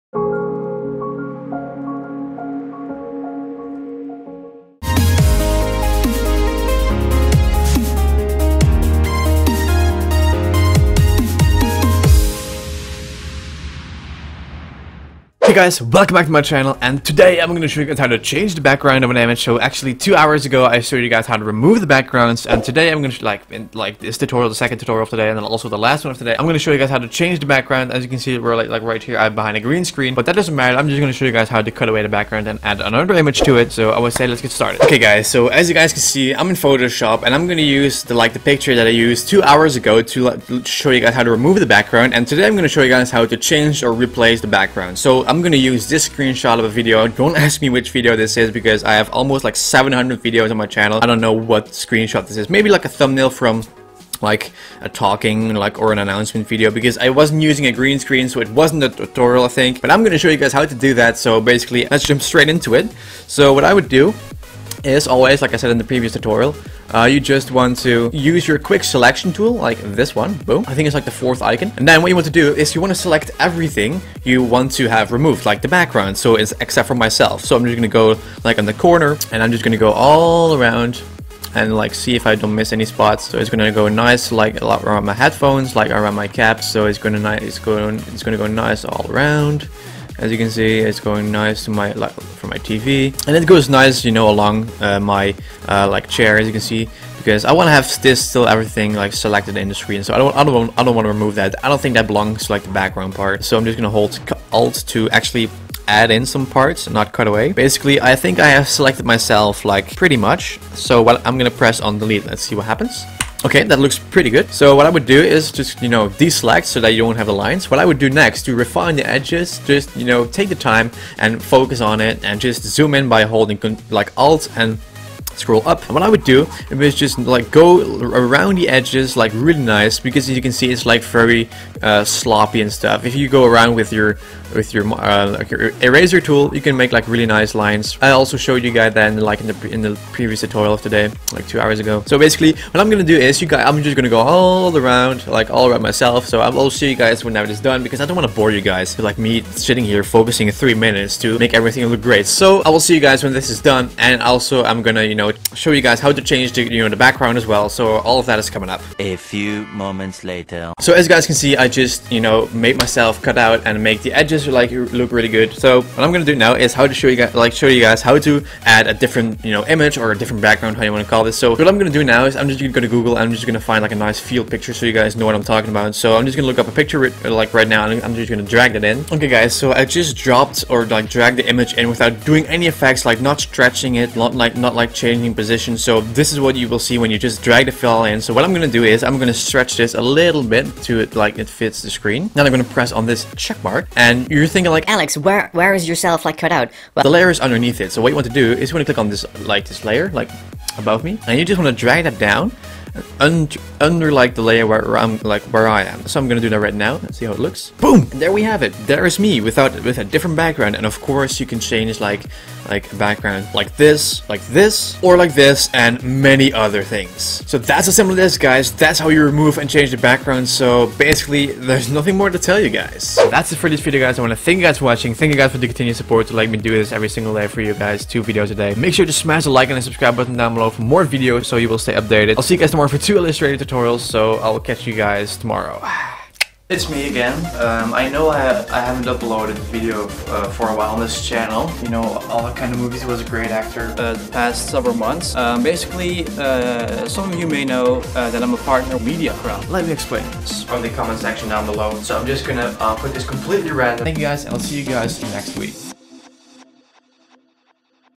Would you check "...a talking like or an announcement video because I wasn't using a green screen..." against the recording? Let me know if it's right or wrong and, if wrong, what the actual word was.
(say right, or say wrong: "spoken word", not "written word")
right.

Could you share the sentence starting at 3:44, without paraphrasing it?
I wanna thank you guys for watching.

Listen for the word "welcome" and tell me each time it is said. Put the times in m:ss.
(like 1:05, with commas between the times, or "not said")
0:15.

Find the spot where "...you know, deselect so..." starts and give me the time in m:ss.
1:55.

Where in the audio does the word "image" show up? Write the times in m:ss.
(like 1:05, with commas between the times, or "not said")
0:19, 0:33, 2:49, 3:01.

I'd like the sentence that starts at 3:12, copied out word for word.
Then I'm going to press on this check mark and you're thinking like, Alex, where where is yourself like cut out?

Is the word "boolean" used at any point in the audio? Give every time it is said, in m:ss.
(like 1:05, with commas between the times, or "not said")
not said.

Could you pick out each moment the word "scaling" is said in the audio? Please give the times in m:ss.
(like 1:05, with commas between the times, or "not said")
not said.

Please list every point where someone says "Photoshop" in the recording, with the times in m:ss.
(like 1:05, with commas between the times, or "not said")
0:36.